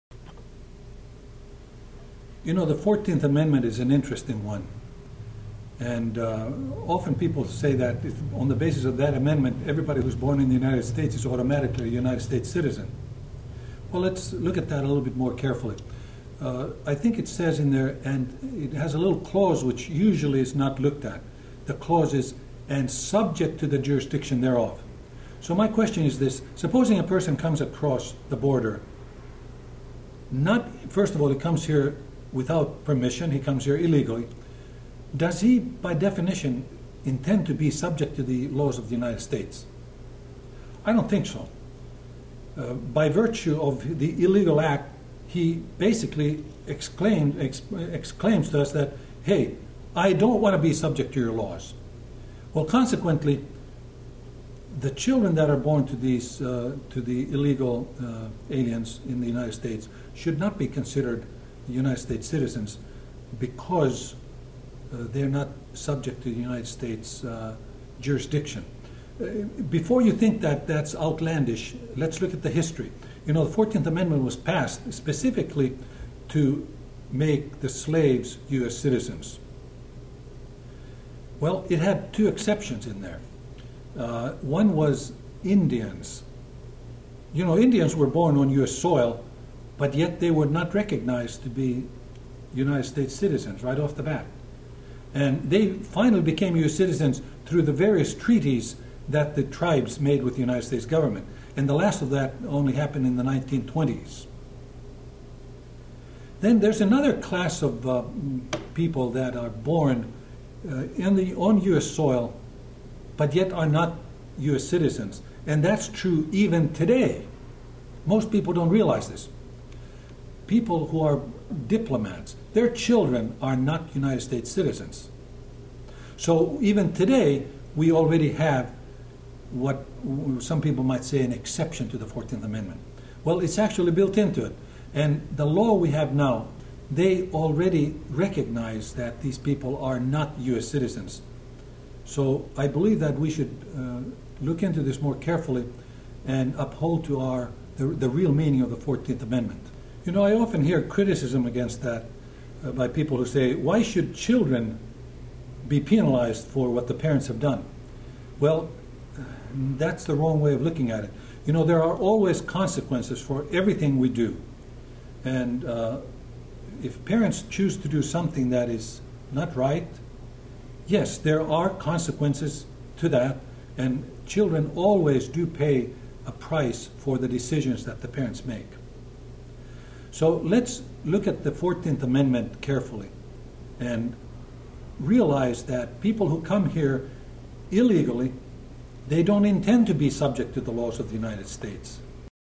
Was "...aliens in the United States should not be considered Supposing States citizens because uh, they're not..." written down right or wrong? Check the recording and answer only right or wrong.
wrong.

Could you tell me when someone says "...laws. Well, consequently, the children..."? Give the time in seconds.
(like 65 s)
51 s.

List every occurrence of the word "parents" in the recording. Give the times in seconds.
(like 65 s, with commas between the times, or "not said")
156 s, 167 s, 178 s.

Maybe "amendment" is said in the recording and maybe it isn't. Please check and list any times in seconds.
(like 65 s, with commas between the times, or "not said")
3 s, 9 s, 73 s, 132 s, 149 s, 182 s.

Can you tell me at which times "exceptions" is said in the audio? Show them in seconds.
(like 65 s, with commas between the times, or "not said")
82 s, 131 s.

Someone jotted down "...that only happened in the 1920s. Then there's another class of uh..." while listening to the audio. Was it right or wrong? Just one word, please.
right.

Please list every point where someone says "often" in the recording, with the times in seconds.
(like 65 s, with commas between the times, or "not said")
6 s, 150 s.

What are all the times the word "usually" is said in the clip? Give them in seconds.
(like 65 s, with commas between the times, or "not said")
19 s.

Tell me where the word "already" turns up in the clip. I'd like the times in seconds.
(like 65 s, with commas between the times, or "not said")
127 s, 137 s.